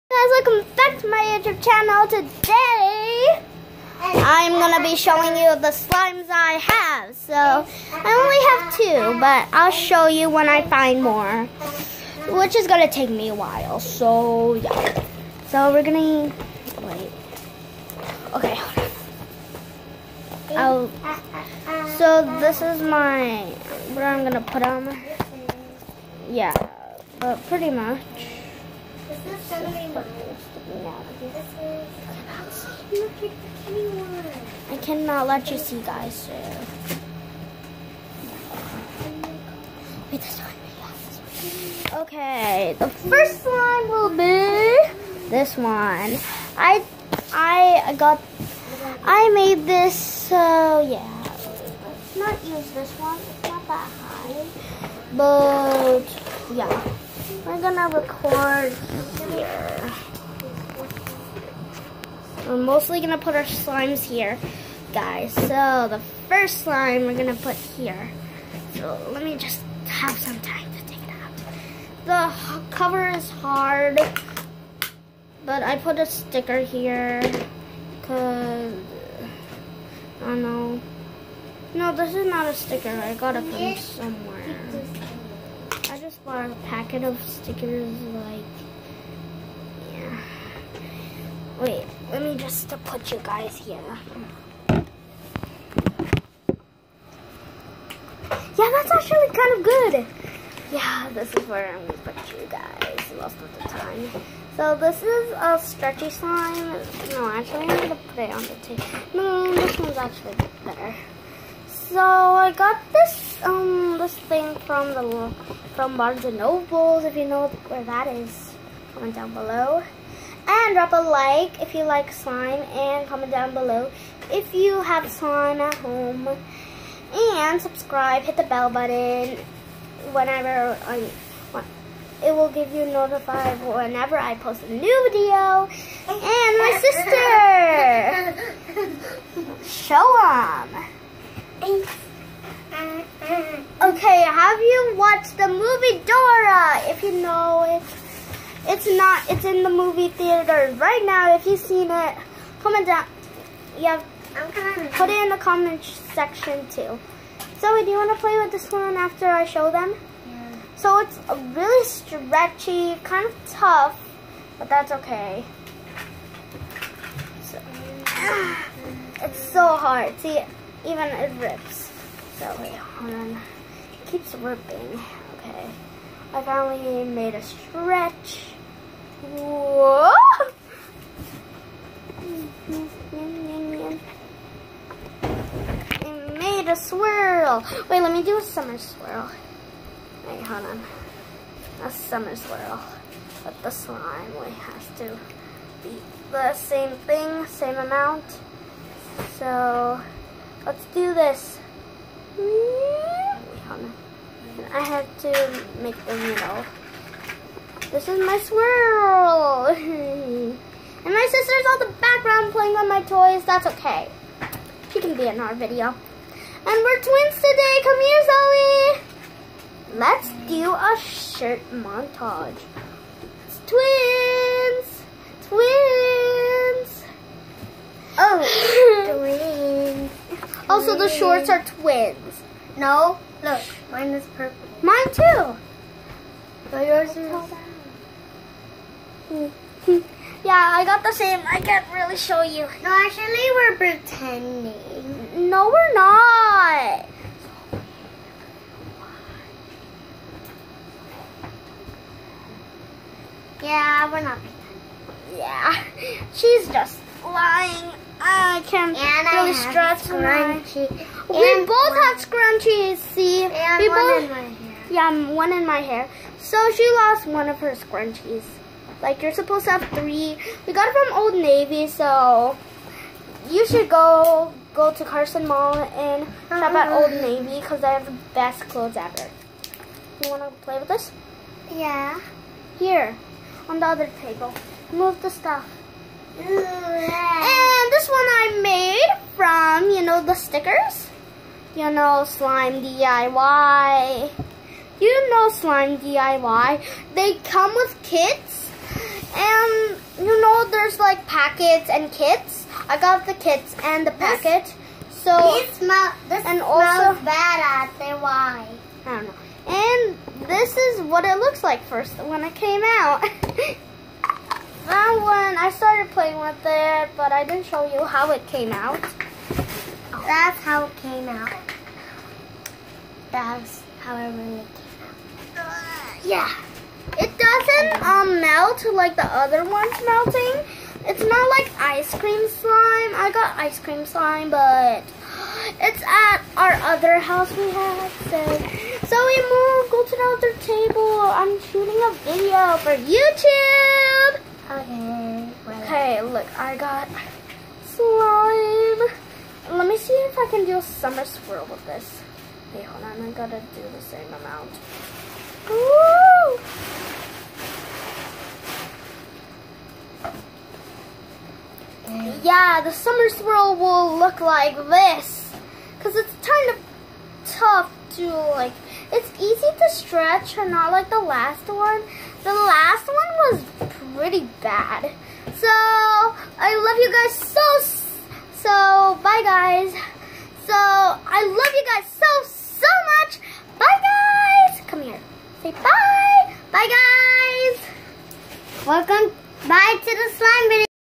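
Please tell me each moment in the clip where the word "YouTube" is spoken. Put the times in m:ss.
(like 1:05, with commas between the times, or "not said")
0:01, 5:43.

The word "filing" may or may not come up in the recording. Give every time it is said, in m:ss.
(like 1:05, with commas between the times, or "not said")
not said.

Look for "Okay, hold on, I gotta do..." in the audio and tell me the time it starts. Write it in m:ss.
5:52.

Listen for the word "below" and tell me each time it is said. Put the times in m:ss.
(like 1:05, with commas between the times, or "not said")
1:59, 2:03.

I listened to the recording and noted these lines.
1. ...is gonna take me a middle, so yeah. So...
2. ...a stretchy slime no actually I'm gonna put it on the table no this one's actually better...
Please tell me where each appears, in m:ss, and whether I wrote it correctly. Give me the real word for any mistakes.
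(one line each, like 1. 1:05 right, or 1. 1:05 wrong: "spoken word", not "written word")
1. 0:12 wrong: "while", not "middle"
2. 1:45 right.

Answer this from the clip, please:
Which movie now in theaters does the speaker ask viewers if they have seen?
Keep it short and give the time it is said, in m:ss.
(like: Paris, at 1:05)
Dora, at 2:26.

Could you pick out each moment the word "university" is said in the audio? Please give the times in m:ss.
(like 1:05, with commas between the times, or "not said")
not said.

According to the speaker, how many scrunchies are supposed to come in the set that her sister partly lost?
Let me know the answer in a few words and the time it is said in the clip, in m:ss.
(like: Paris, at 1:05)
3, at 4:29.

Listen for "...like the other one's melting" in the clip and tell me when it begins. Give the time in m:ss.
5:28.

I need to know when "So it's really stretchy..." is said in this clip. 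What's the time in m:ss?
2:40.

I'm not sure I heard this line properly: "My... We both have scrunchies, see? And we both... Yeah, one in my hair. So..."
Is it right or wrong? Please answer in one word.
right.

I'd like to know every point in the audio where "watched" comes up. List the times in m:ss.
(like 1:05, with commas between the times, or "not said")
2:24.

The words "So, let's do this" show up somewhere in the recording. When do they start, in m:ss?
3:19.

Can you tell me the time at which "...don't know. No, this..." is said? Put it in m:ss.
1:20.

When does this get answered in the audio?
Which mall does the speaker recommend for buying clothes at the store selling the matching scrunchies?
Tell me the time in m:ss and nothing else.
4:35.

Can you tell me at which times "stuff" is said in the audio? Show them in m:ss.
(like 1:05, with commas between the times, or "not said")
4:45.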